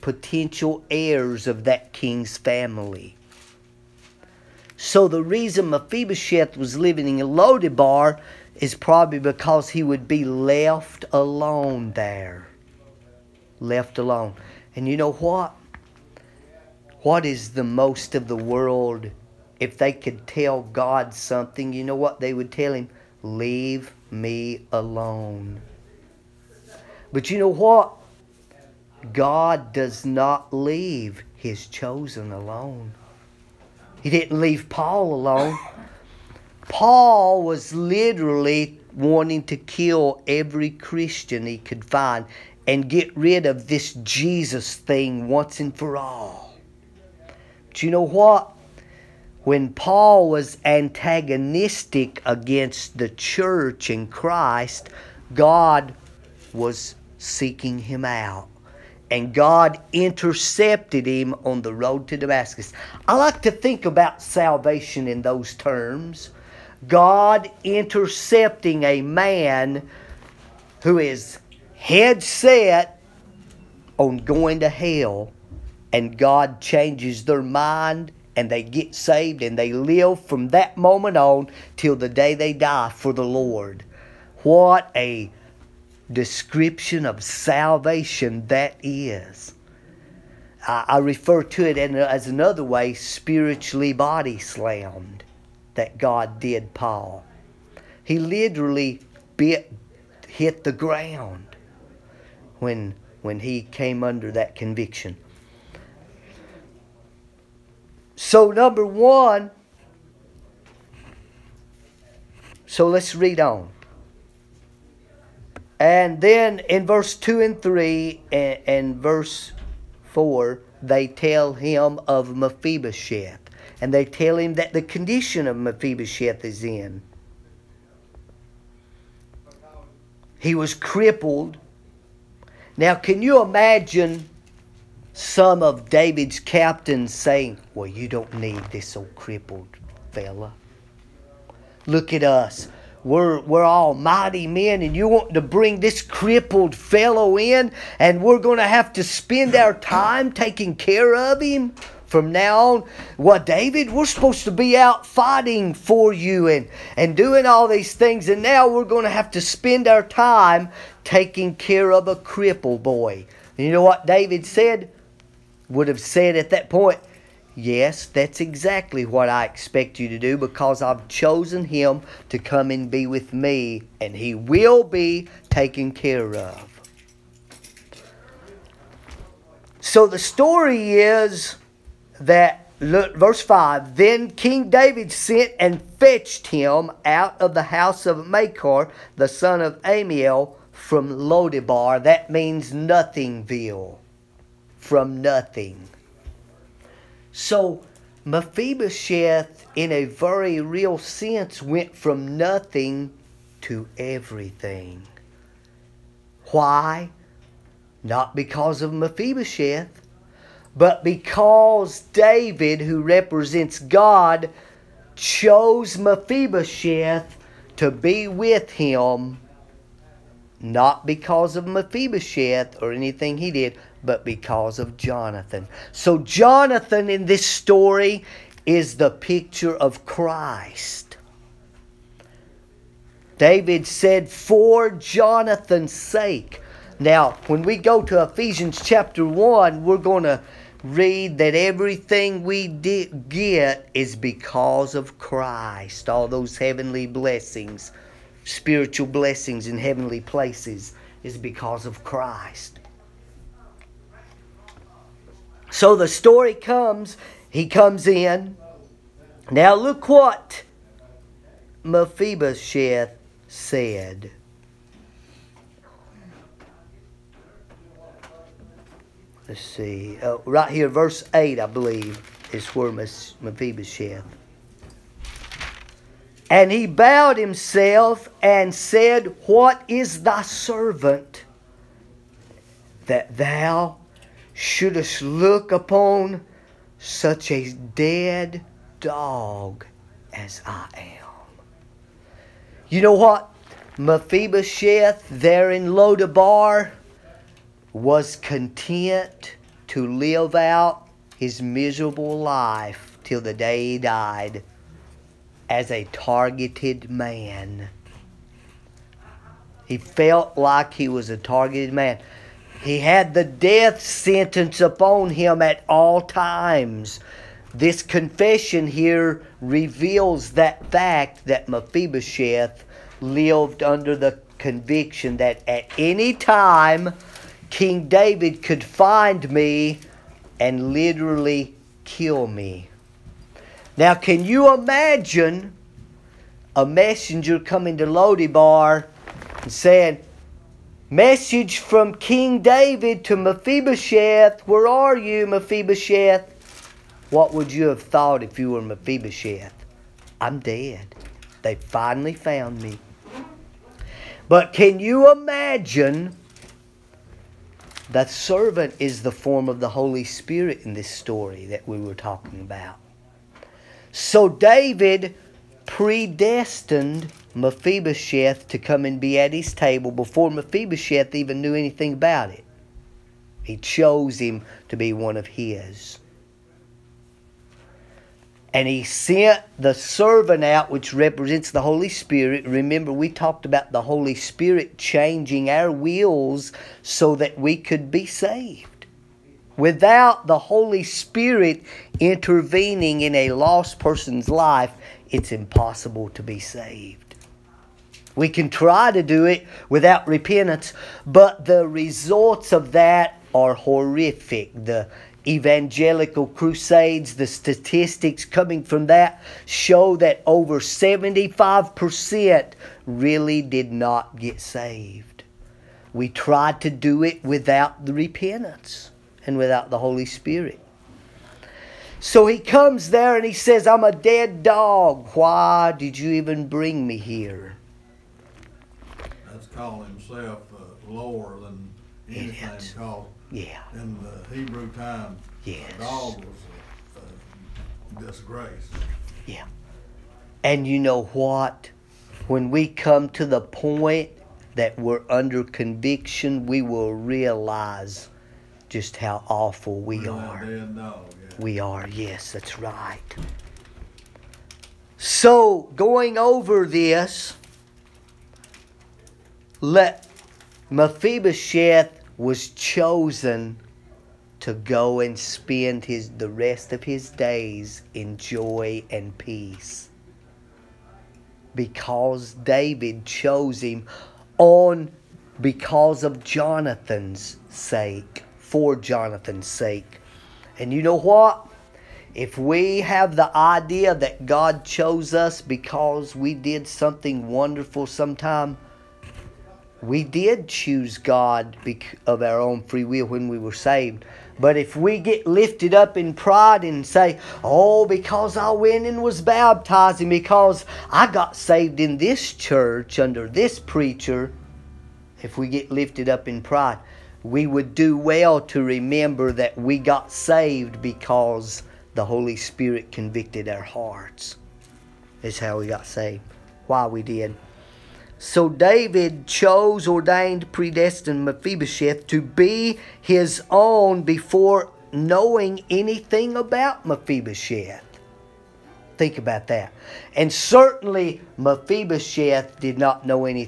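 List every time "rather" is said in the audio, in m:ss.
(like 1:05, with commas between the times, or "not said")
not said.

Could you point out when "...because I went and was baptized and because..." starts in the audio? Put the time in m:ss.
8:18.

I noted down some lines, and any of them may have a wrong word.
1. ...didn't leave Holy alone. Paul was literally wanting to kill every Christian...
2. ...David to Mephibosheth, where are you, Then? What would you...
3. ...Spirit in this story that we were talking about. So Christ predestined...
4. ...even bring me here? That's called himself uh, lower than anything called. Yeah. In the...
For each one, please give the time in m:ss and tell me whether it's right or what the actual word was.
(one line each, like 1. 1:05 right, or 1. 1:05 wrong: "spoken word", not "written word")
1. 0:34 wrong: "Paul", not "Holy"
2. 5:42 wrong: "Mephibosheth", not "Then"
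3. 6:00 wrong: "David", not "Christ"
4. 7:06 right.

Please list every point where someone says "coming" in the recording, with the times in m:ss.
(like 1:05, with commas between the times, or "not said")
5:37, 6:48.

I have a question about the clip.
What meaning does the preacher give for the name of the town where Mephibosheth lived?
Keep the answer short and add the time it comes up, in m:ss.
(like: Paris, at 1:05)
nothingville, at 3:12.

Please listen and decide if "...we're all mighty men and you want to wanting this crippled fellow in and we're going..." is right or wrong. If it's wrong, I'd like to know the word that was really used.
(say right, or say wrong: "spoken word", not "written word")
wrong: "bring", not "wanting".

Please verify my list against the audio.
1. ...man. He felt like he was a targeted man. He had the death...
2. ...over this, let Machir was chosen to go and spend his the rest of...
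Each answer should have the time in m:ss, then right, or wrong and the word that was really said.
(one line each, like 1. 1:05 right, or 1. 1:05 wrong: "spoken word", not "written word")
1. 5:07 right
2. 7:36 wrong: "Mephibosheth", not "Machir".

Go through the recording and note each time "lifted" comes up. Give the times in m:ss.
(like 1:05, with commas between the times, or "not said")
8:15, 8:25.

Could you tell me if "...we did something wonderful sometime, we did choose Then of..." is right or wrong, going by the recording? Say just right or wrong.
wrong.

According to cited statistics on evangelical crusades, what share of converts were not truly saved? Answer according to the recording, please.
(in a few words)
over 75%.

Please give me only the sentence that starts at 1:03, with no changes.
I like to think about salvation in those terms.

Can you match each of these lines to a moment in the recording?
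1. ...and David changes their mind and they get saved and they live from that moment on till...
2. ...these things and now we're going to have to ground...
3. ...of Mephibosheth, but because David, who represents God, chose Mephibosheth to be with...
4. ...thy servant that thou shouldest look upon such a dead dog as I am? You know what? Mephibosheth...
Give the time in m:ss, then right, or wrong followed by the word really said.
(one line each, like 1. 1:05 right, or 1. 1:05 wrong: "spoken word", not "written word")
1. 1:15 wrong: "God", not "David"
2. 2:37 wrong: "spend", not "ground"
3. 3:28 right
4. 4:40 right.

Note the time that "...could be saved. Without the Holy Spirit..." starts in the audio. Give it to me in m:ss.
6:27.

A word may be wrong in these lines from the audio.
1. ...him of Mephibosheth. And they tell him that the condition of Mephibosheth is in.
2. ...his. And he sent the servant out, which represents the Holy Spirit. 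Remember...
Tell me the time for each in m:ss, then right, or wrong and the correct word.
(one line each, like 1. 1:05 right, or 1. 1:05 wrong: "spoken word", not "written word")
1. 2:01 right
2. 6:15 right.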